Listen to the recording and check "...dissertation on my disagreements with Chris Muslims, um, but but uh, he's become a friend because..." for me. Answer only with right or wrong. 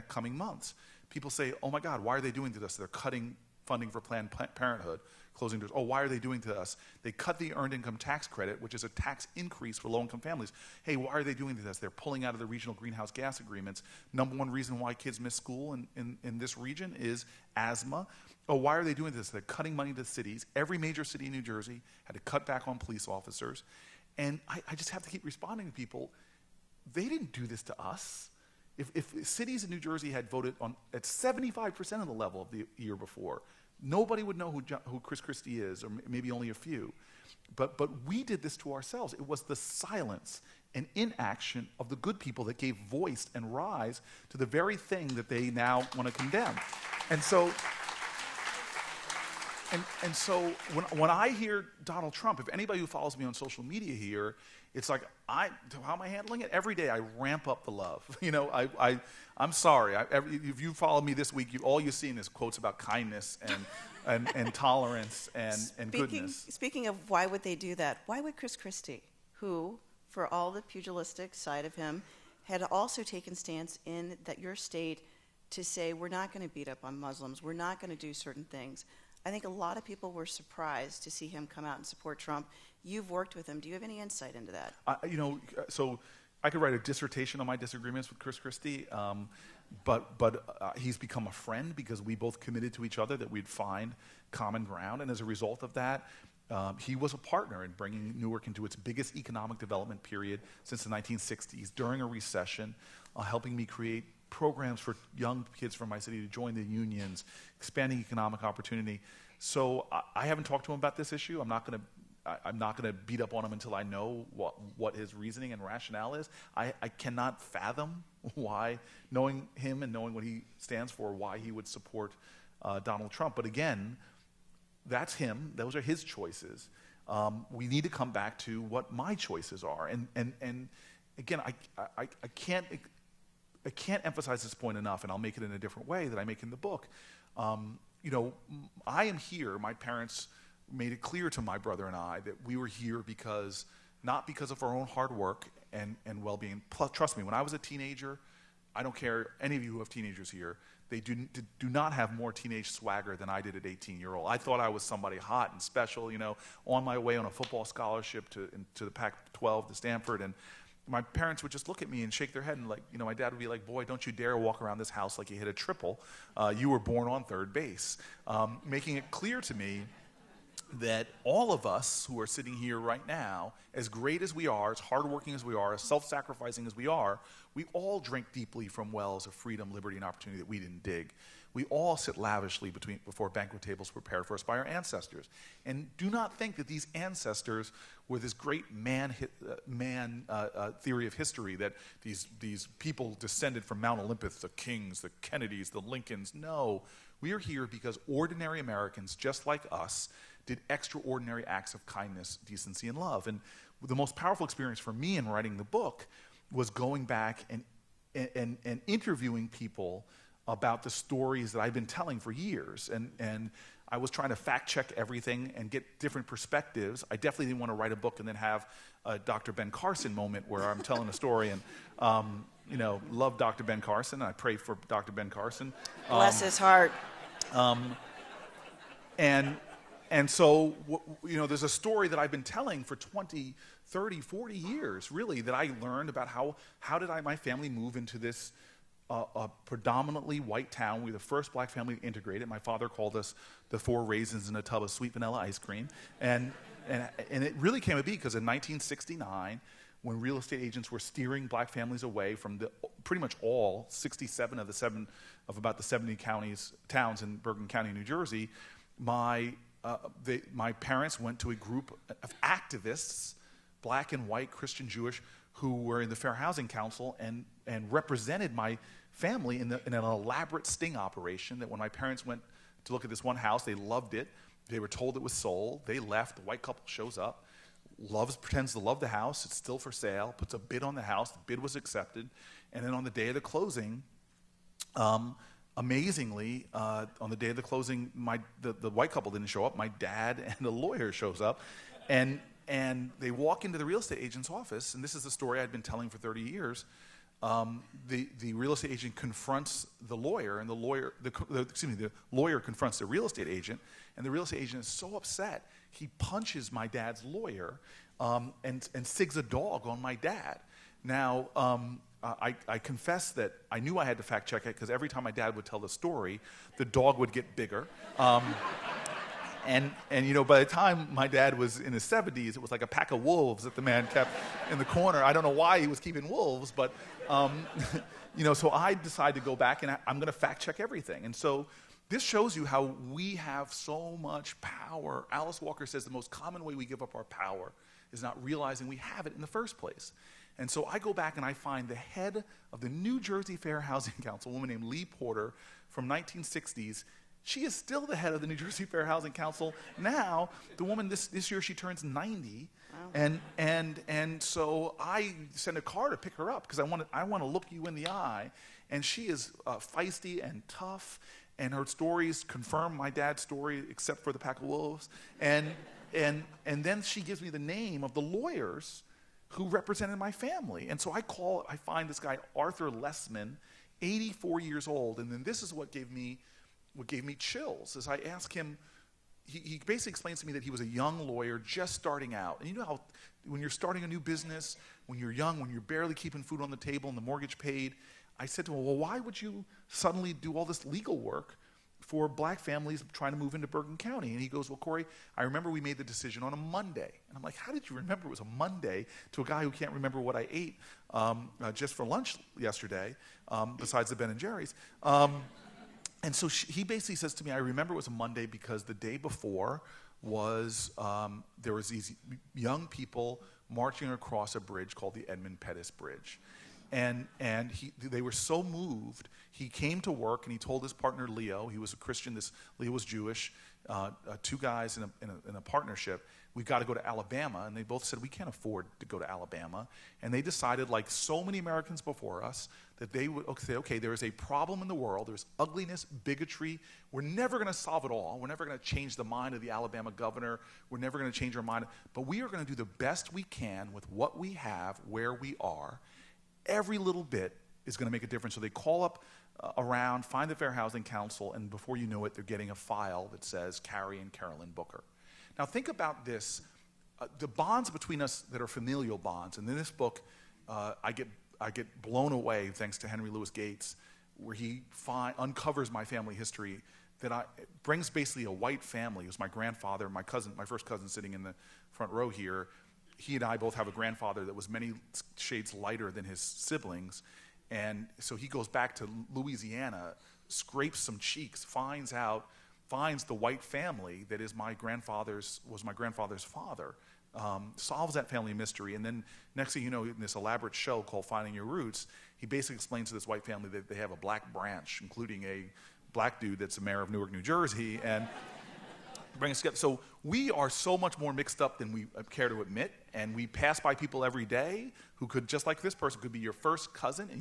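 wrong.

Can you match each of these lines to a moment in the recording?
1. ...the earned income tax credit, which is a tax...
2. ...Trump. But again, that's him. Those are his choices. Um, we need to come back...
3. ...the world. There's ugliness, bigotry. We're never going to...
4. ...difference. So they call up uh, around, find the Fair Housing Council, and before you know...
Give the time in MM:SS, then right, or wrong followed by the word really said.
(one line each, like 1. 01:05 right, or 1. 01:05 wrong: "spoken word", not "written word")
1. 00:07 right
2. 02:03 right
3. 07:14 right
4. 07:28 right.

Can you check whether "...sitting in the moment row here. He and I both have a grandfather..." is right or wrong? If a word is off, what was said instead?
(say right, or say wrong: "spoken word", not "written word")
wrong: "front", not "moment".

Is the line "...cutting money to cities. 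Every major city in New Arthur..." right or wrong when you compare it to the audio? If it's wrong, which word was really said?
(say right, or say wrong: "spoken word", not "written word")
wrong: "Jersey", not "Arthur".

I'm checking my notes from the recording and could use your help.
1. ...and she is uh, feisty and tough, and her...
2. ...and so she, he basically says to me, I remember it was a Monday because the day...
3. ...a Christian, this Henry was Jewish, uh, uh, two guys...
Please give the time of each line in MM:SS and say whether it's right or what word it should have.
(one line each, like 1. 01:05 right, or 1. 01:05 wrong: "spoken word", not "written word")
1. 05:58 right
2. 06:46 right
3. 07:01 wrong: "Leo", not "Henry".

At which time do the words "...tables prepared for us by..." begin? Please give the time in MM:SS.
03:03.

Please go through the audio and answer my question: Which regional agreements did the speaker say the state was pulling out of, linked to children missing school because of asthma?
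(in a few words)
Regional greenhouse gas agreements.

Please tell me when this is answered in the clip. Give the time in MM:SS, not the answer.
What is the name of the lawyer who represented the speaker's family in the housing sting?
06:12.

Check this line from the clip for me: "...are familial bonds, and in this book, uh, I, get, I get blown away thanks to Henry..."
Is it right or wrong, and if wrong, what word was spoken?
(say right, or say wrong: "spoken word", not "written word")
right.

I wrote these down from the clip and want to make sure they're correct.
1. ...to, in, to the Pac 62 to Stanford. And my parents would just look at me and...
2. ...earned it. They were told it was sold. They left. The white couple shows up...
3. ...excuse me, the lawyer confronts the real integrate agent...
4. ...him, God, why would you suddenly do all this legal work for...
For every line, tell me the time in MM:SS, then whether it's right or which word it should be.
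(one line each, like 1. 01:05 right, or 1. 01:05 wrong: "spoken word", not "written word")
1. 02:38 wrong: "12", not "62"
2. 04:33 wrong: "loved", not "earned"
3. 05:01 wrong: "estate", not "integrate"
4. 06:28 wrong: "Well", not "God".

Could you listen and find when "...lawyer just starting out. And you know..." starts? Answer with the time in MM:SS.
06:21.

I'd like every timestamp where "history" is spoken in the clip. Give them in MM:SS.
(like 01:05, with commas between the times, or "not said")
03:11, 07:46.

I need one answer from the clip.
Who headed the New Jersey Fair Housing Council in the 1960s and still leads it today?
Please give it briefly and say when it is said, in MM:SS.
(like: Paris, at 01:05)
Lee Porter, at 05:44.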